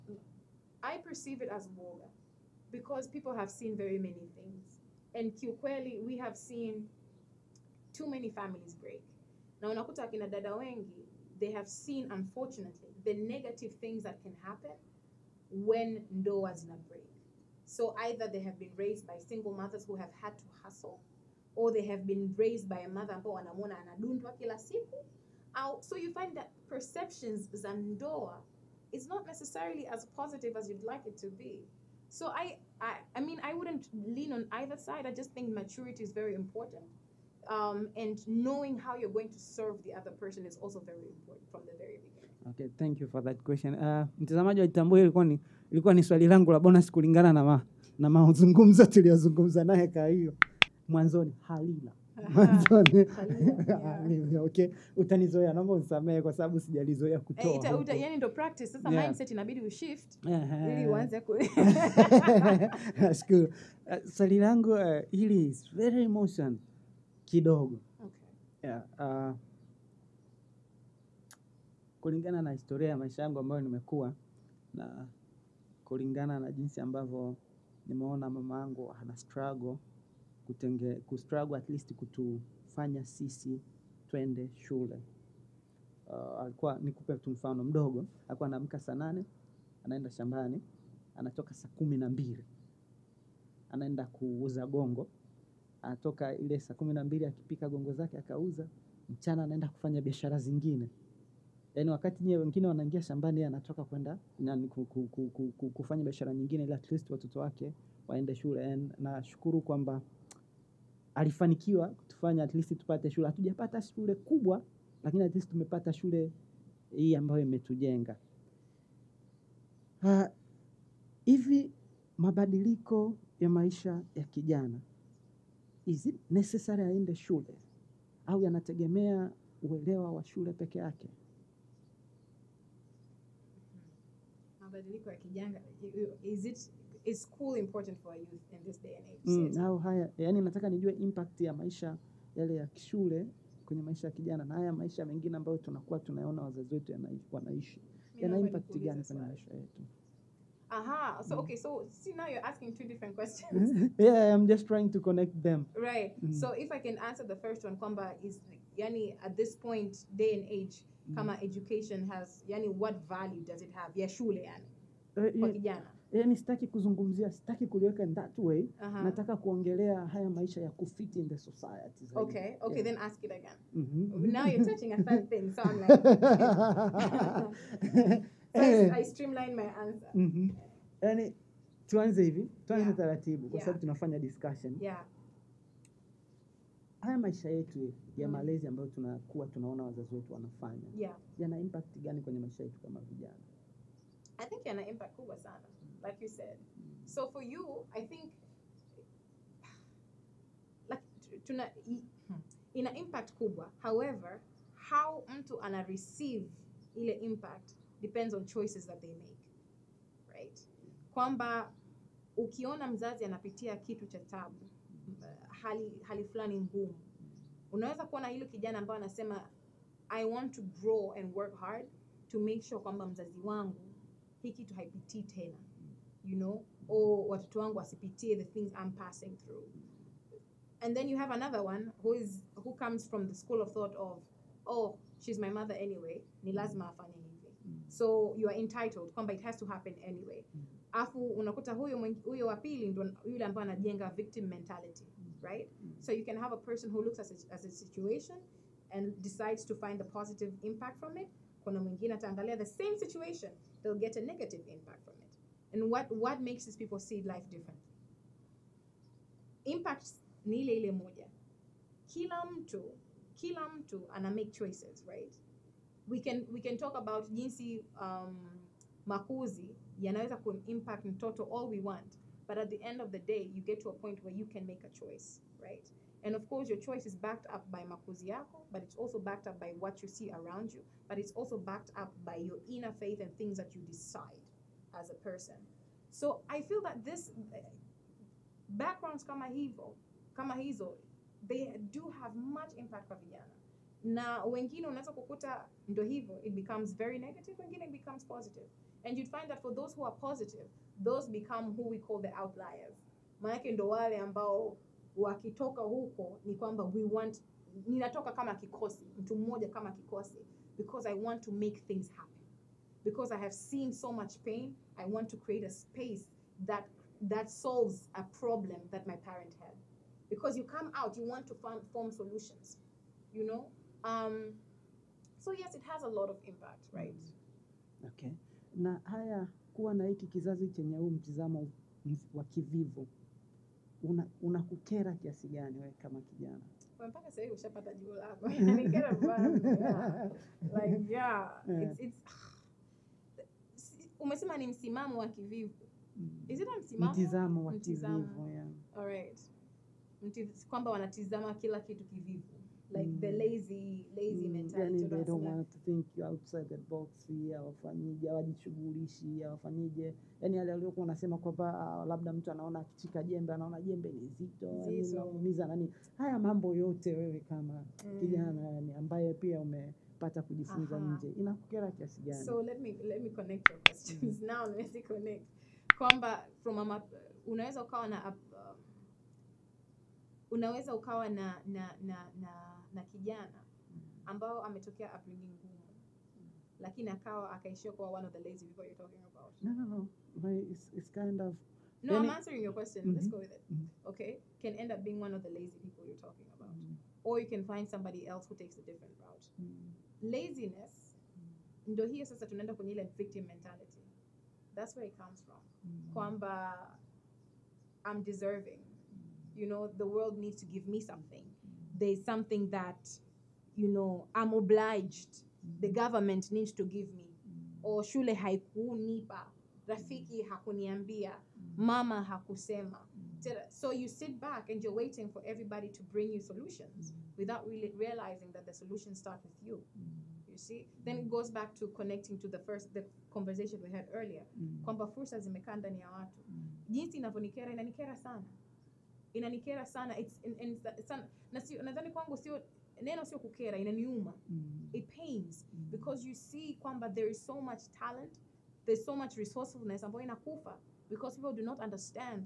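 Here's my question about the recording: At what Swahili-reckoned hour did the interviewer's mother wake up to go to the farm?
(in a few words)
saa nane.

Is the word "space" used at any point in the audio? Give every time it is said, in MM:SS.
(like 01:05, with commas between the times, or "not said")
05:15.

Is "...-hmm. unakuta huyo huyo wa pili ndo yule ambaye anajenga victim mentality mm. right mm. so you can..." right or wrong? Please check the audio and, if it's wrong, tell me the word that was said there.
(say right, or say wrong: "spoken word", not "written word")
right.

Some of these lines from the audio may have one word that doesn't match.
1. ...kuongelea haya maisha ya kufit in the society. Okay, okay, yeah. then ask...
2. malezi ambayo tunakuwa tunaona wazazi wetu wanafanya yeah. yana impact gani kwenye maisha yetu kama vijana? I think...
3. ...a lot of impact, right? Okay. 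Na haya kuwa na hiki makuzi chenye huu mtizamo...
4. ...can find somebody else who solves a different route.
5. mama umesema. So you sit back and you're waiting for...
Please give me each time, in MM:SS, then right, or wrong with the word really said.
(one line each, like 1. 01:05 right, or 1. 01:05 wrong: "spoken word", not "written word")
1. 02:49 right
2. 03:08 right
3. 05:26 wrong: "kizazi", not "makuzi"
4. 06:37 wrong: "takes", not "solves"
5. 07:01 wrong: "hakusema", not "umesema".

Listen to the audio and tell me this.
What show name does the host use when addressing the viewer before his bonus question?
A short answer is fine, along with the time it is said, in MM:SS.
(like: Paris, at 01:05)
Itambue, at 00:44.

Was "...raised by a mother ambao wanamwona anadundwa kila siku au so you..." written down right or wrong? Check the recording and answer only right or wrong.
right.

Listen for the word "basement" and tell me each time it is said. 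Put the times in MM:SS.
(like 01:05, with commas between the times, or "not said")
not said.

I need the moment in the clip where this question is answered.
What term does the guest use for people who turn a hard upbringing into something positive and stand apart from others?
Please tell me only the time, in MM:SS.
05:02.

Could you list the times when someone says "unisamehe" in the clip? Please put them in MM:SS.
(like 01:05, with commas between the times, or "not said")
00:55.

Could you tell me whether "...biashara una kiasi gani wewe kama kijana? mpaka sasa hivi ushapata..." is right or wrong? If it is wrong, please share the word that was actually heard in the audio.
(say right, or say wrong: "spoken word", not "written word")
wrong: "unakukera", not "biashara".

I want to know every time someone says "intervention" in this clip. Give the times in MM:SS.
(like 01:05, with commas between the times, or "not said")
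not said.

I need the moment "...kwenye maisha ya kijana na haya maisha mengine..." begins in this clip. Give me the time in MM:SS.
02:23.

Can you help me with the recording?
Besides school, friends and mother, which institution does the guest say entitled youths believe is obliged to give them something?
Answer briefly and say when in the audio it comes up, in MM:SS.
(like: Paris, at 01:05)
the government, at 06:55.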